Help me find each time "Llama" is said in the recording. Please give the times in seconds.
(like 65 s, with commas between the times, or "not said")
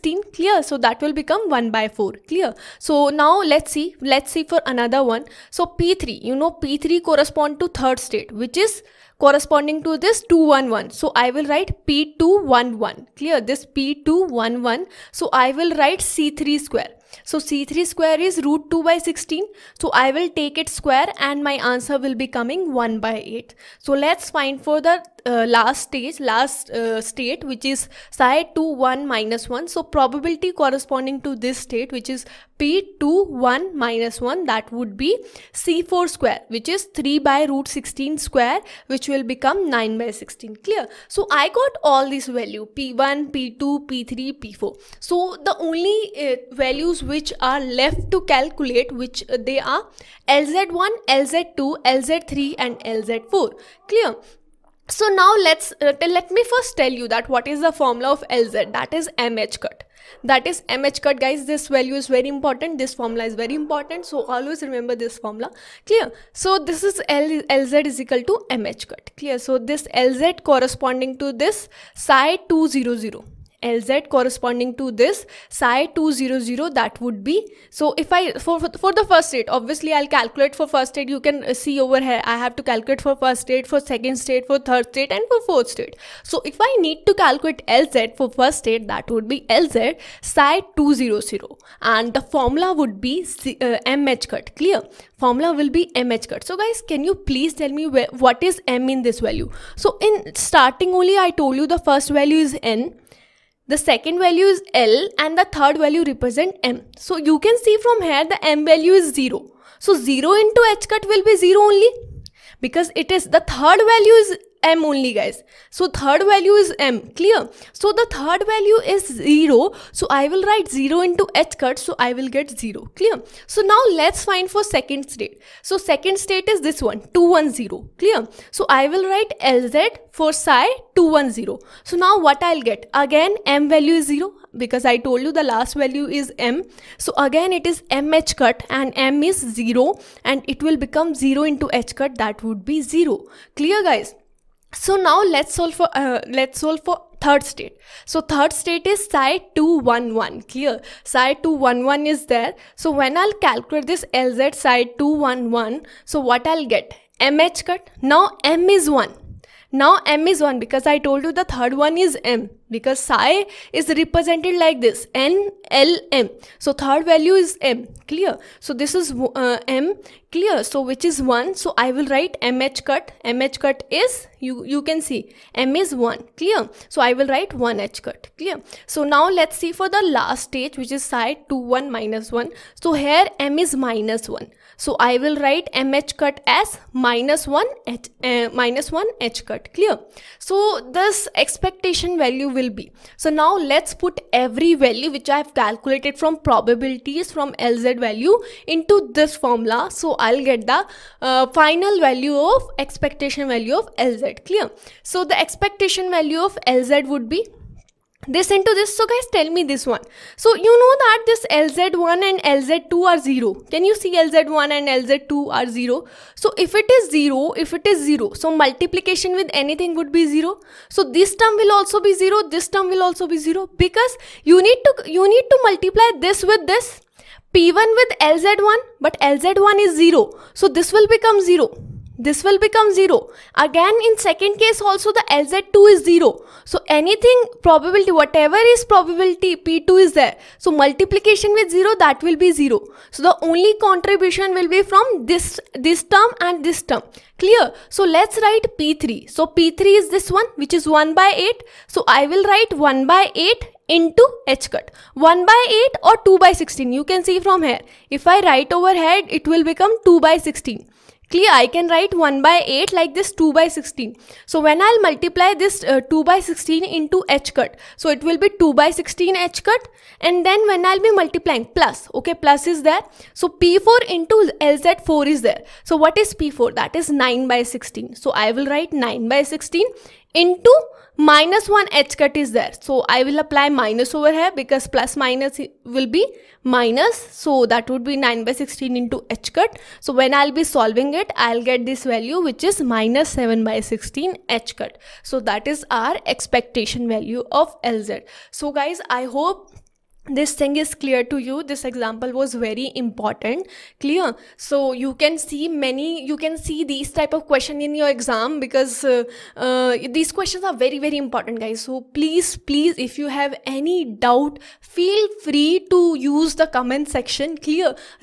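not said.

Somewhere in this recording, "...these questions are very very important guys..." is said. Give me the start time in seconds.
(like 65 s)
310 s.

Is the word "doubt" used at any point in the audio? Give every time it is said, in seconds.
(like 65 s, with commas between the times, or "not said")
314 s.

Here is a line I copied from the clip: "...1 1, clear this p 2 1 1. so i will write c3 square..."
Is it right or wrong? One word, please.
right.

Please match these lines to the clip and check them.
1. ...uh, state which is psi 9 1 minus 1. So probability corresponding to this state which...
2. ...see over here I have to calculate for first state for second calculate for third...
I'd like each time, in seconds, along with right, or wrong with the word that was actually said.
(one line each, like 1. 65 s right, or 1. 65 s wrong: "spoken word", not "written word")
1. 26 s wrong: "2", not "9"
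2. 81 s wrong: "state", not "calculate".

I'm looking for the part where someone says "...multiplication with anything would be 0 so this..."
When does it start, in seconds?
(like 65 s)
218 s.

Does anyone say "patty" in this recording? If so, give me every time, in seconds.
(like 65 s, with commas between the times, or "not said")
not said.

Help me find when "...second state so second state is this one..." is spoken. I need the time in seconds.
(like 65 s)
124 s.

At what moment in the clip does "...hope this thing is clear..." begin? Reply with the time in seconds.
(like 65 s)
299 s.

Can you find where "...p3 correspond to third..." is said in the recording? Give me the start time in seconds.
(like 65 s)
6 s.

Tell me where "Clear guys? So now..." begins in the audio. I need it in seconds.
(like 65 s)
143 s.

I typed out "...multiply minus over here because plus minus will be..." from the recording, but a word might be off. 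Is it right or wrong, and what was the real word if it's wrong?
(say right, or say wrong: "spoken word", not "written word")
wrong: "apply", not "multiply".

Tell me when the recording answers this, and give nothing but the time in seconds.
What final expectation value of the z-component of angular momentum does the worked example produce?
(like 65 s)
292 s.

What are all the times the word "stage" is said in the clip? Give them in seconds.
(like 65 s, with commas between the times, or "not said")
25 s, 180 s.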